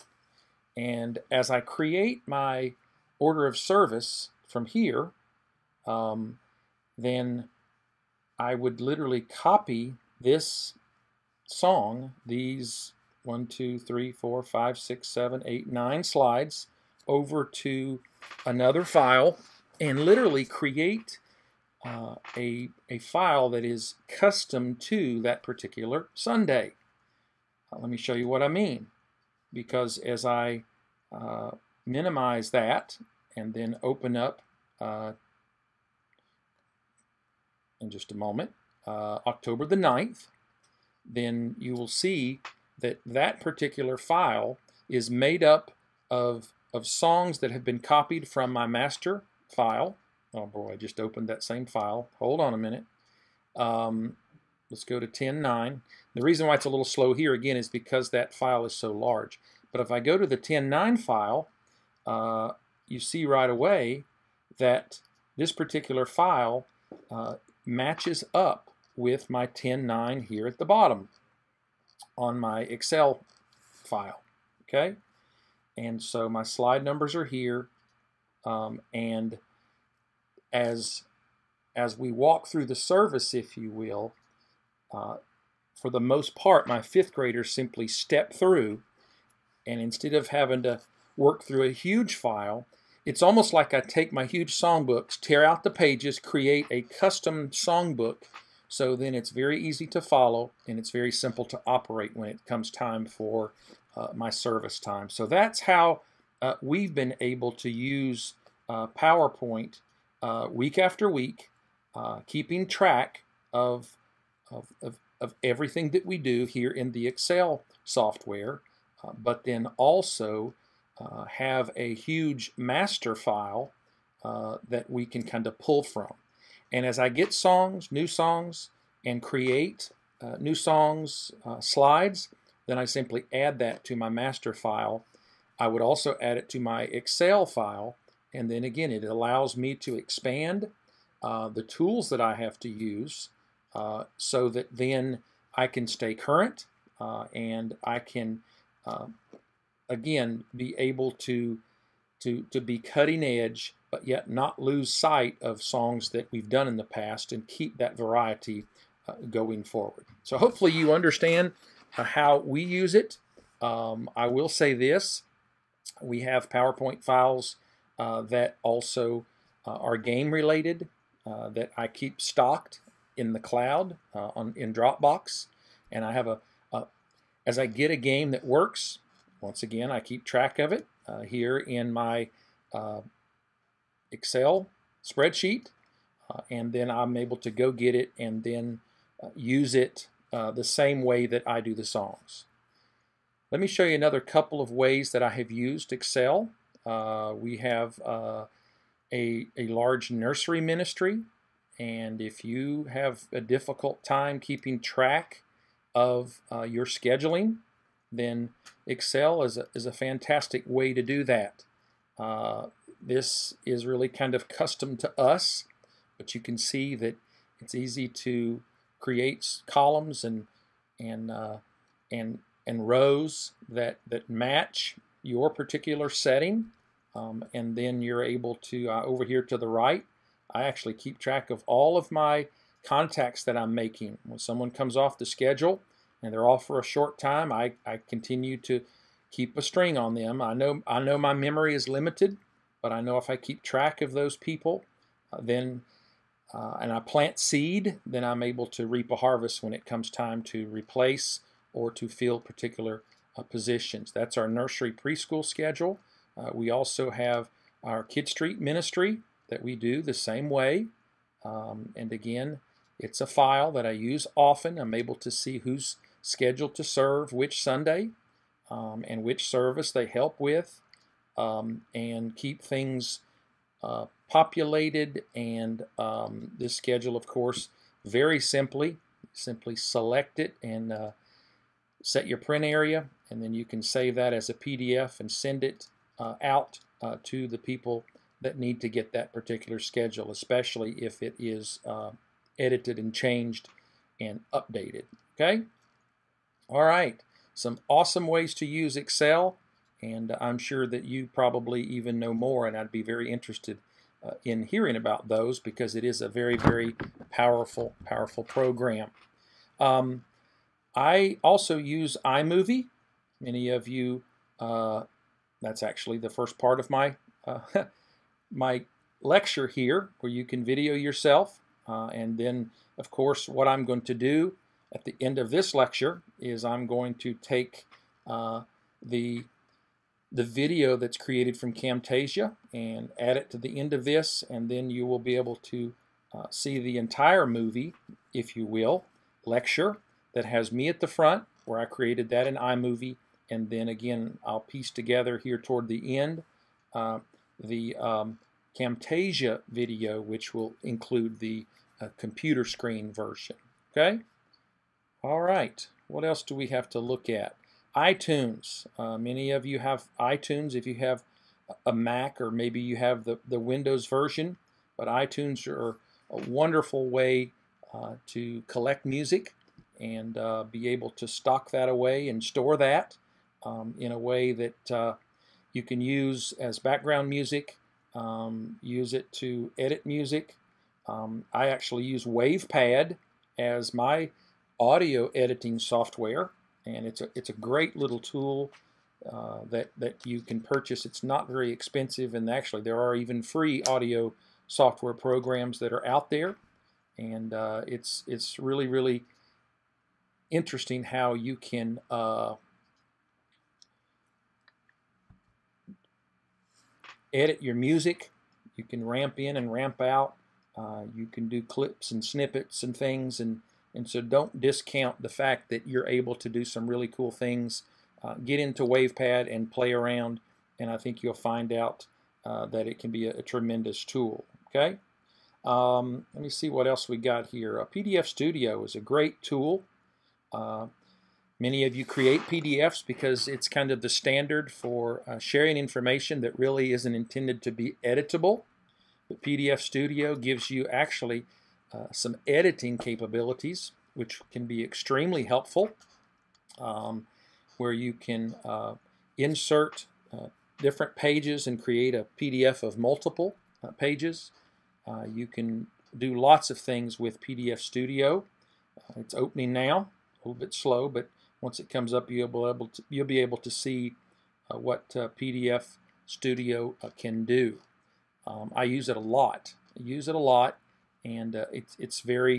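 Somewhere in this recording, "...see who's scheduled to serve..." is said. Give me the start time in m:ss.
4:25.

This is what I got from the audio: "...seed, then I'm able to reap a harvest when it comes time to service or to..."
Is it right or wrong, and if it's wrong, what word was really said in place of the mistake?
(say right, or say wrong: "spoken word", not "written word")
wrong: "replace", not "service".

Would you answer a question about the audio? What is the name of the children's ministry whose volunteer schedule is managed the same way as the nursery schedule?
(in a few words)
Kid Street.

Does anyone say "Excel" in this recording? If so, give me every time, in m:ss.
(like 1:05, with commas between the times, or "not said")
1:12, 1:57, 2:16, 3:04, 3:15, 3:28, 4:58.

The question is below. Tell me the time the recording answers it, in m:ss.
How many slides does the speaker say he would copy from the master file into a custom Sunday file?
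0:15.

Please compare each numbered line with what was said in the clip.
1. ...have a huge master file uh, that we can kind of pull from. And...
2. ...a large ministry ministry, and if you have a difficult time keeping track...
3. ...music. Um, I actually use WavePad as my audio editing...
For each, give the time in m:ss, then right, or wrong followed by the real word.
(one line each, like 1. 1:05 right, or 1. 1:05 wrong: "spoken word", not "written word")
1. 2:01 right
2. 3:19 wrong: "nursery", not "ministry"
3. 6:20 right.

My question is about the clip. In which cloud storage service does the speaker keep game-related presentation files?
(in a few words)
Dropbox.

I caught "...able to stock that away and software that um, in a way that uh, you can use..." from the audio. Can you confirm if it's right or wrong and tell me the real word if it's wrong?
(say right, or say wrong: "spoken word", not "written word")
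wrong: "store", not "software".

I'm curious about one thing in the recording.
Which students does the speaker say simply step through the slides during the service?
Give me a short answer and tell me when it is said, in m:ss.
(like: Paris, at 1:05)
fifth graders, at 1:26.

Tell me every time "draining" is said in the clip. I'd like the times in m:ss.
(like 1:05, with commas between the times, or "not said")
not said.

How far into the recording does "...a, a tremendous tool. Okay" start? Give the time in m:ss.
7:03.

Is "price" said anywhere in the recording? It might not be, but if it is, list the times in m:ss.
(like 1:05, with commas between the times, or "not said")
not said.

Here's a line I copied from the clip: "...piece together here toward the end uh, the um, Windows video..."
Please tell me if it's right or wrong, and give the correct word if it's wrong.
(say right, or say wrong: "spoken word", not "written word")
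wrong: "Camtasia", not "Windows".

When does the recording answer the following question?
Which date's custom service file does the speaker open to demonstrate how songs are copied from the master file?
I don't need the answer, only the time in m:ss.
0:39.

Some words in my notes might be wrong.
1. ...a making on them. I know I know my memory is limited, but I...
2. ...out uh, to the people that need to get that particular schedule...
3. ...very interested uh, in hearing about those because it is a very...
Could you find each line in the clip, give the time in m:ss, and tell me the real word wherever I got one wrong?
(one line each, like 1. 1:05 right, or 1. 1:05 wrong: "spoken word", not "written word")
1. 3:59 wrong: "string", not "making"
2. 4:46 right
3. 5:03 right.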